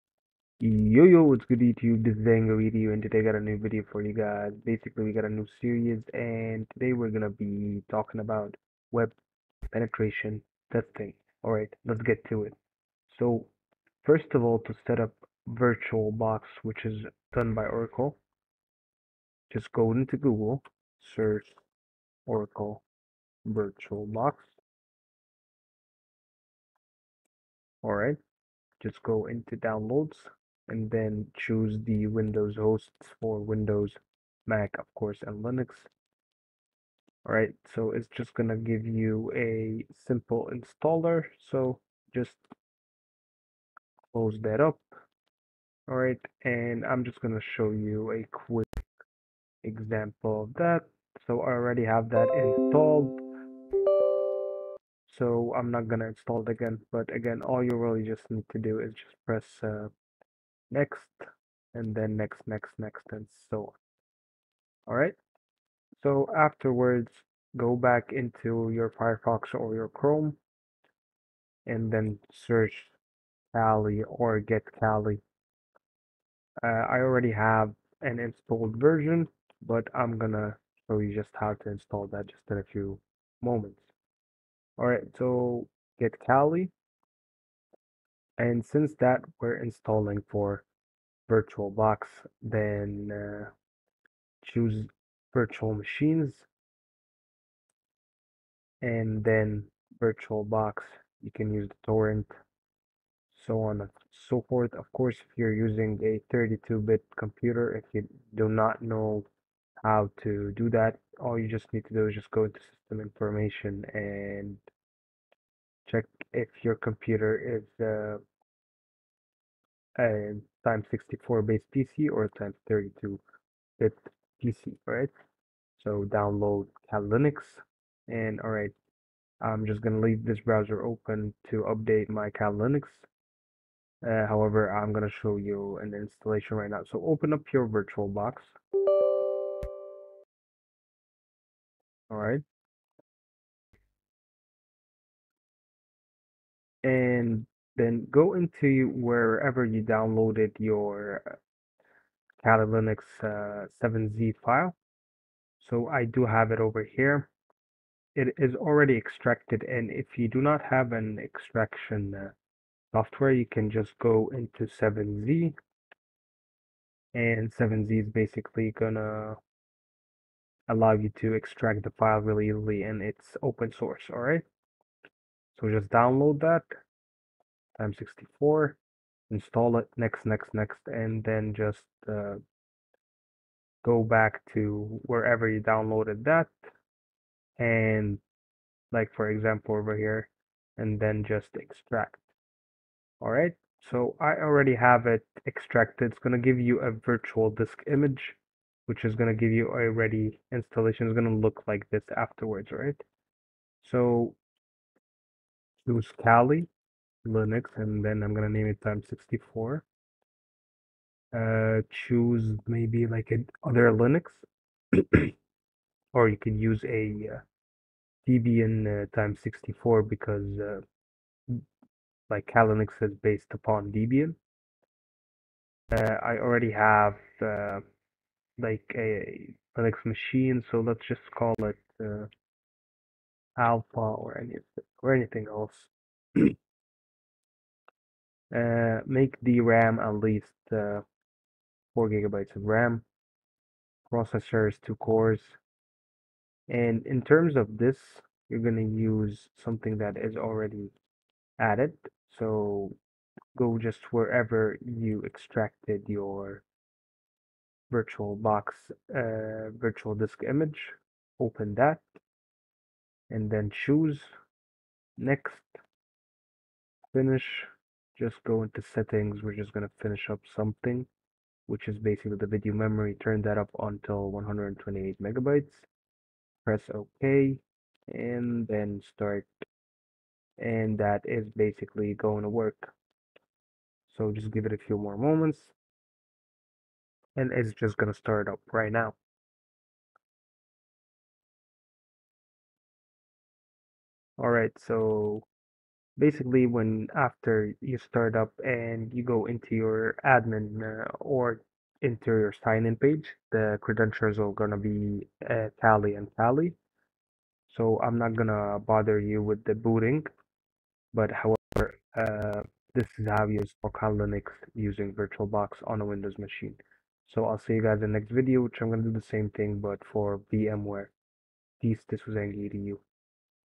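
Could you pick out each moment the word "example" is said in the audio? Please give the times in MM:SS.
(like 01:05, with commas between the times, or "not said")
00:49, 03:09.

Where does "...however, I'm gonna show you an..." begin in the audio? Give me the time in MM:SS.
02:14.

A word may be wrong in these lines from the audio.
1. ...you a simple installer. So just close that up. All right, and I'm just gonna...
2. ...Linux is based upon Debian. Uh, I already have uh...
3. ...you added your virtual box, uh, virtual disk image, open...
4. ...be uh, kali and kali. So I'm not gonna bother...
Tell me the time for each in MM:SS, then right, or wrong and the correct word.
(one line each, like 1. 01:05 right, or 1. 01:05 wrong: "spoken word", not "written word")
1. 00:38 right
2. 03:42 right
3. 04:14 wrong: "extracted", not "added"
4. 05:04 right.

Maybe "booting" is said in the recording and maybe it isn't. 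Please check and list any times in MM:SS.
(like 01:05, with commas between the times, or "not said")
05:09.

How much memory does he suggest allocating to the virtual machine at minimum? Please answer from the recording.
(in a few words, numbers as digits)
4 gigabytes.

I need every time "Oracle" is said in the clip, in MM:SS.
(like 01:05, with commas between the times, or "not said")
00:17, 00:22.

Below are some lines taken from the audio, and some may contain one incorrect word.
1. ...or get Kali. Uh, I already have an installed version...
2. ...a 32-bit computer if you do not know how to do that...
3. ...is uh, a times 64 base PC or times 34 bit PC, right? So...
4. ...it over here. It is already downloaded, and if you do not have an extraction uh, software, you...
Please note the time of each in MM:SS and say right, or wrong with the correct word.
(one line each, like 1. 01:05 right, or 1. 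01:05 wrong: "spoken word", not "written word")
1. 01:14 right
2. 01:46 right
3. 01:57 wrong: "32", not "34"
4. 02:36 wrong: "extracted", not "downloaded".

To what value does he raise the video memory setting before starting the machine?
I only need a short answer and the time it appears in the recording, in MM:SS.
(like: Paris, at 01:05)
128 megabytes, at 04:34.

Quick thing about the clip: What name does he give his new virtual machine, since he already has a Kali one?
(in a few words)
Alpha.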